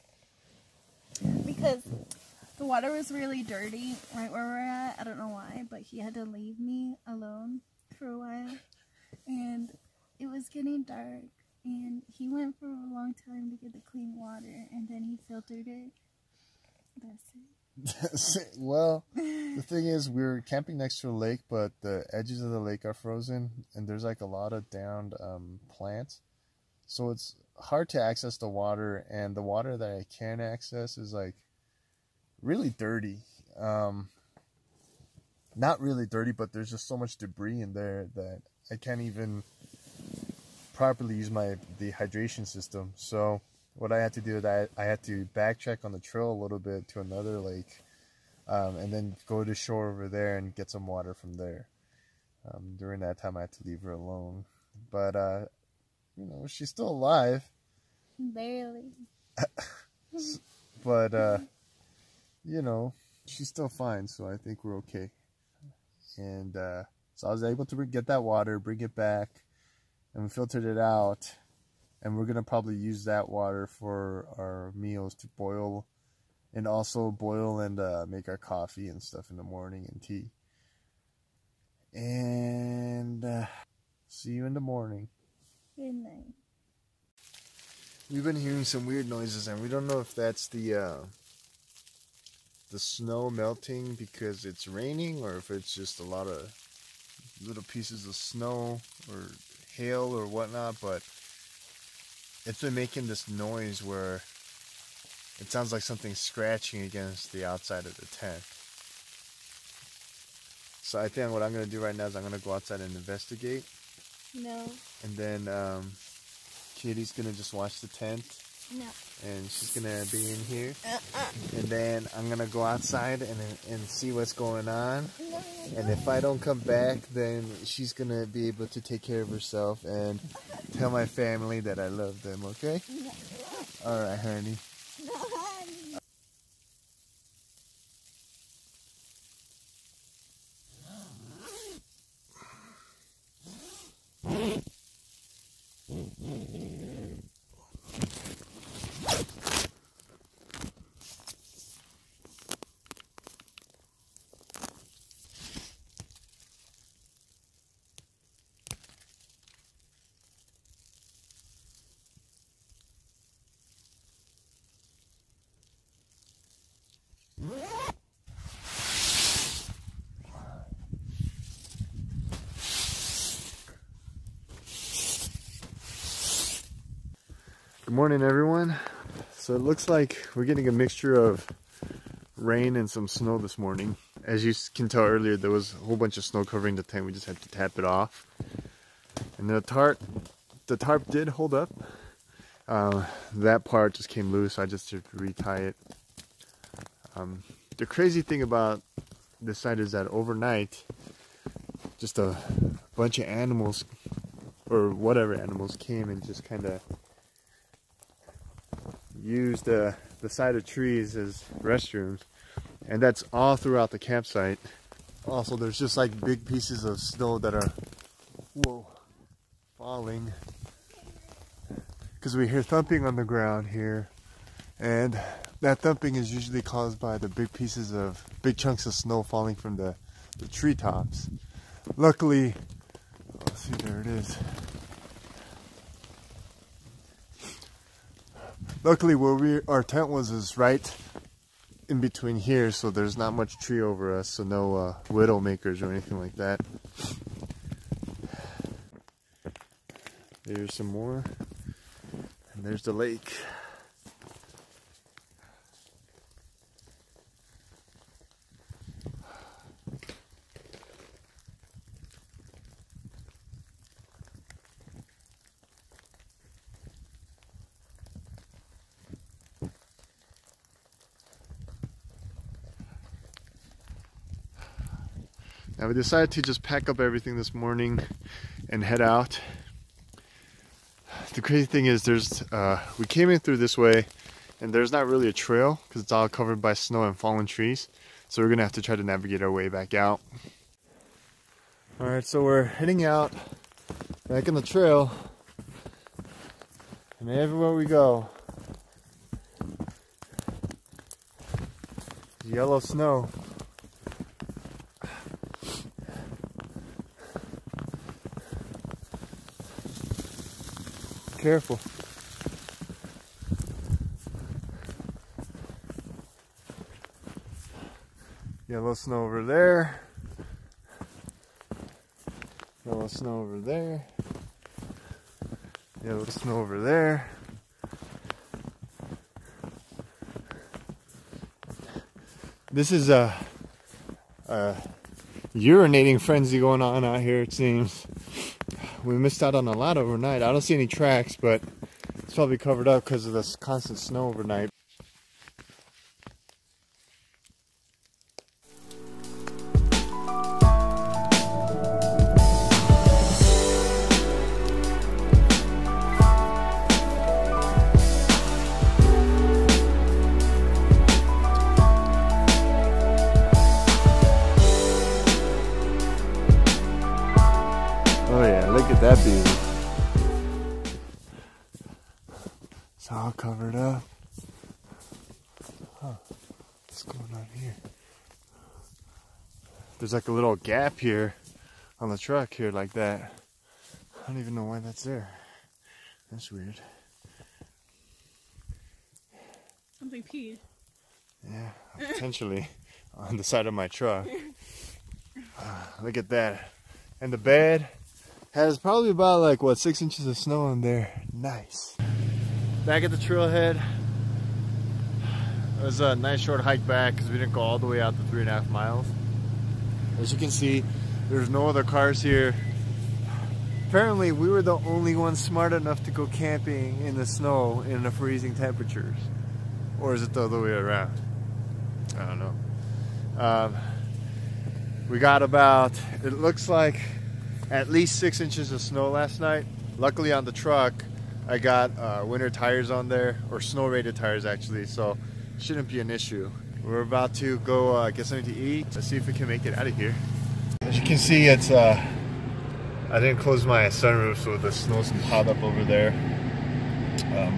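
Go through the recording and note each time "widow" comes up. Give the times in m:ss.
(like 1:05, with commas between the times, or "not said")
4:05.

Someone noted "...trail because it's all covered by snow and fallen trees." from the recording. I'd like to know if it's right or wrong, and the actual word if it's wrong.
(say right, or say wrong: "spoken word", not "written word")
right.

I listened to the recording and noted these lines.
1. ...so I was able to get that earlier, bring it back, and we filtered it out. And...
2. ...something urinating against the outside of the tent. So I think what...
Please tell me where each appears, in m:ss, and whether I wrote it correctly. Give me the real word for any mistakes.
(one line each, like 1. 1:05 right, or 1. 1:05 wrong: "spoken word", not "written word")
1. 1:07 wrong: "water", not "earlier"
2. 1:45 wrong: "scratching", not "urinating".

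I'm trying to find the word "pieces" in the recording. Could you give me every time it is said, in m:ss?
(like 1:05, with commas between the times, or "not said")
1:37, 3:36, 3:47.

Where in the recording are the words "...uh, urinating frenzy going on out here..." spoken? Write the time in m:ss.
5:34.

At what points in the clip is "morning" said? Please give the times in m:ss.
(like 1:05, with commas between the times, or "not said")
1:19, 1:24, 2:57, 3:03, 4:37.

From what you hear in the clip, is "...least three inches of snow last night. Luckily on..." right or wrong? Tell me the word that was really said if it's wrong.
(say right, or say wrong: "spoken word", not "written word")
wrong: "six", not "three".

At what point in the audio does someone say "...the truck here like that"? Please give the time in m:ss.
6:22.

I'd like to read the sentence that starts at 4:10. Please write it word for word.
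There's some more, and there's the lake.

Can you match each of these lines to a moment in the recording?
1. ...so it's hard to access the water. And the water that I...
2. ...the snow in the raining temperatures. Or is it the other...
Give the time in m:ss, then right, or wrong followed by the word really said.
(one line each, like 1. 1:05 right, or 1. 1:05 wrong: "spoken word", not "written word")
1. 0:26 right
2. 6:57 wrong: "freezing", not "raining".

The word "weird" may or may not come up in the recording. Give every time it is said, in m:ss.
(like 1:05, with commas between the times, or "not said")
1:28, 6:26.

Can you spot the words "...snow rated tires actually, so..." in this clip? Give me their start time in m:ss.
7:13.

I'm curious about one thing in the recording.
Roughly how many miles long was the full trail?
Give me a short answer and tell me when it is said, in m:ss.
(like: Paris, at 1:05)
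3.5, at 6:48.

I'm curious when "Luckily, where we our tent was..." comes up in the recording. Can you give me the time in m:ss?
3:58.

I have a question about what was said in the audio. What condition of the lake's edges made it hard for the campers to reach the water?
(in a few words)
frozen.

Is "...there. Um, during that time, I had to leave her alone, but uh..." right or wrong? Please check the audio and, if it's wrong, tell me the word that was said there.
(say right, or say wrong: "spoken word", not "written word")
right.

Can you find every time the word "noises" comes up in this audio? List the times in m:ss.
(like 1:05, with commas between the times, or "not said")
1:29, 1:43.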